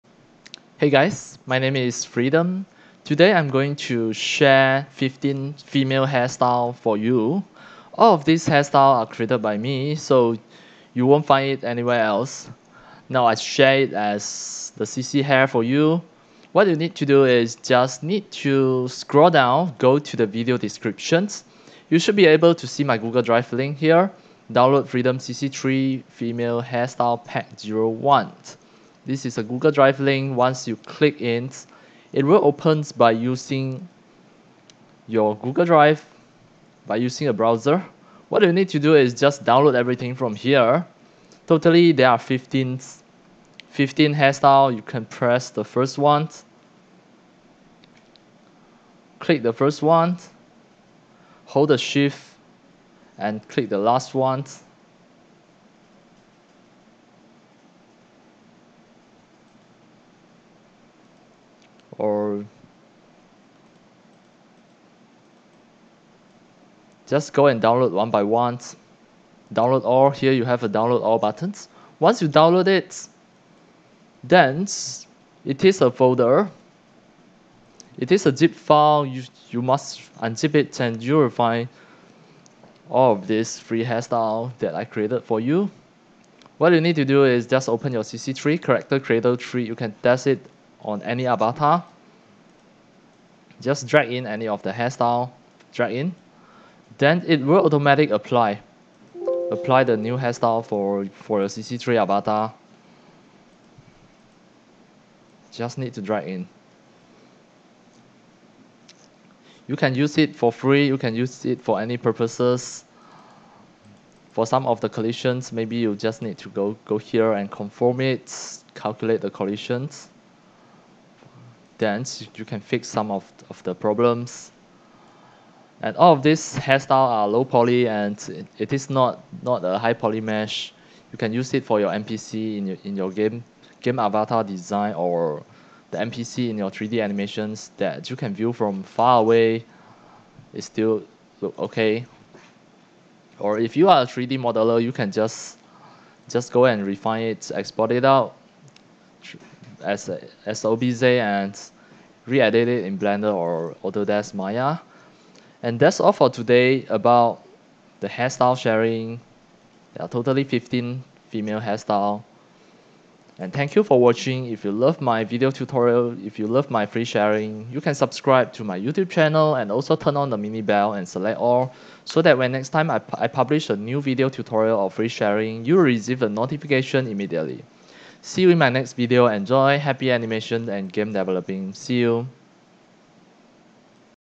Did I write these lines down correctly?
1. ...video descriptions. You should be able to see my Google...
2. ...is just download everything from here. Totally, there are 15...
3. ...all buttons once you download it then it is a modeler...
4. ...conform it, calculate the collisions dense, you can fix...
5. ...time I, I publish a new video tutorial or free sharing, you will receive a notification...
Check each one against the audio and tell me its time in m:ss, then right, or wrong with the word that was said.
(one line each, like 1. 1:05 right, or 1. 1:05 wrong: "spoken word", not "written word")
1. 0:20 right
2. 0:38 right
3. 1:11 wrong: "folder", not "modeler"
4. 1:57 right
5. 2:52 right.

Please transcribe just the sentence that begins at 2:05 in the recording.
And all of these hairstyle are low poly and it is not, not a high poly mesh.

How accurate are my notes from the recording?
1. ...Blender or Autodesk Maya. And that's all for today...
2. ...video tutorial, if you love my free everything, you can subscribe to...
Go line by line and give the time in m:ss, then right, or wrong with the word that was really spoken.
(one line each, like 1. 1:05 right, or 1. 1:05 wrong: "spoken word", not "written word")
1. 2:32 right
2. 2:45 wrong: "sharing", not "everything".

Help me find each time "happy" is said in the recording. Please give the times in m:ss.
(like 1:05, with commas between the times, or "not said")
2:59.